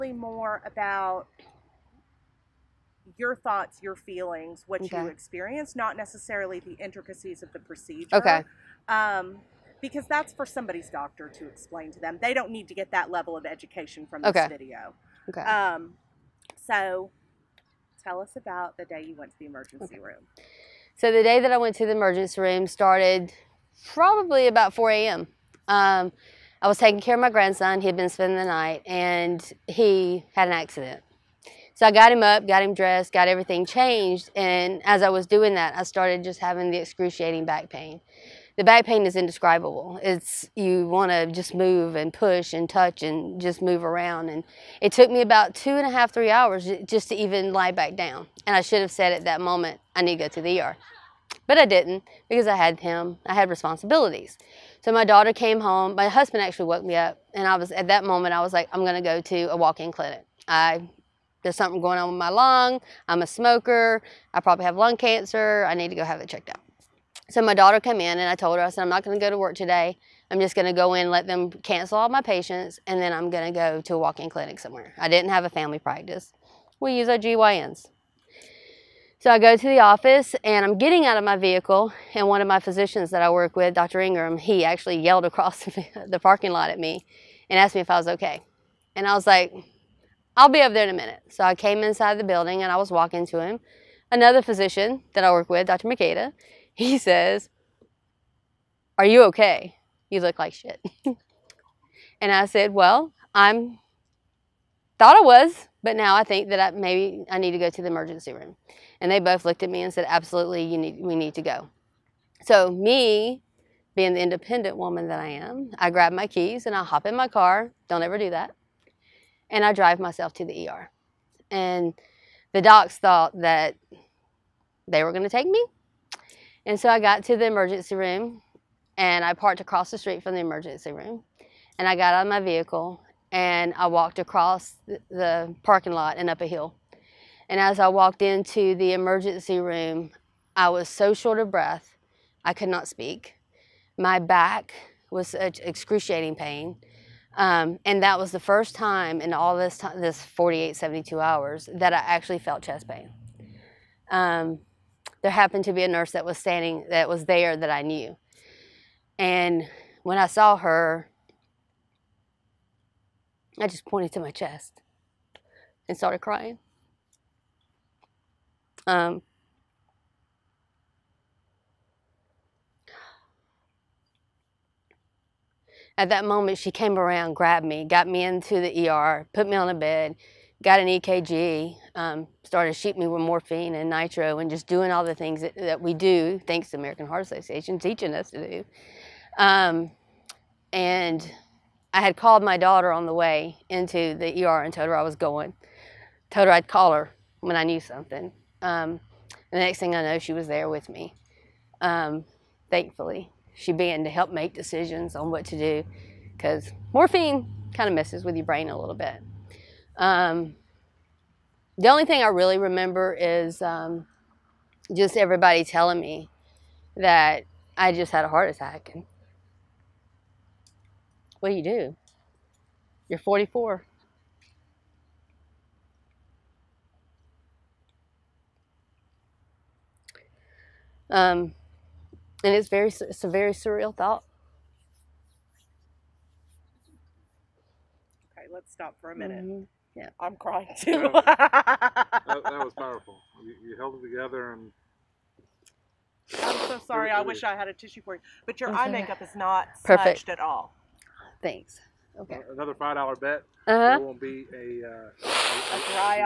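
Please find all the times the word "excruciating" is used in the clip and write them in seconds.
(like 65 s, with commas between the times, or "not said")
36 s, 145 s.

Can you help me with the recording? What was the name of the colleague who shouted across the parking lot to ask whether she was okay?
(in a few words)
Dr. Ingram.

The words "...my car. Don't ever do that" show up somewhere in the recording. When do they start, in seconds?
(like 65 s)
117 s.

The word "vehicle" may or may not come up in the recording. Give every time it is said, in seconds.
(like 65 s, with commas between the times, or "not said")
81 s, 132 s.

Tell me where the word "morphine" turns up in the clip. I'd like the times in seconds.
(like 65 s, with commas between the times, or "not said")
183 s, 206 s.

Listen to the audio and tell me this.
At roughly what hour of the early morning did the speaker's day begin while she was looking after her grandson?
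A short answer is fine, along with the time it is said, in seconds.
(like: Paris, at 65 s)
4 a.m., at 24 s.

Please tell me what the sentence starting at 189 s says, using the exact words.
Um, and I had called my daughter on the way into the ER and told her I was going.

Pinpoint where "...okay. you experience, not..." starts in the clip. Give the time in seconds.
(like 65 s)
4 s.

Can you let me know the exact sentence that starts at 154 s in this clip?
Um, there happened to be a nurse that was standing, that was there that I knew.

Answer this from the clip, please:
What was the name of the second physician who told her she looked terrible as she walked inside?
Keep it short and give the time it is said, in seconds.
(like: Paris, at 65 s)
Dr. Makeda, at 95 s.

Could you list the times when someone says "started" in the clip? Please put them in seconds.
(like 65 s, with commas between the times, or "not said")
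22 s, 35 s, 165 s, 182 s.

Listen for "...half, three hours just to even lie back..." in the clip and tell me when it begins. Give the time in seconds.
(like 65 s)
45 s.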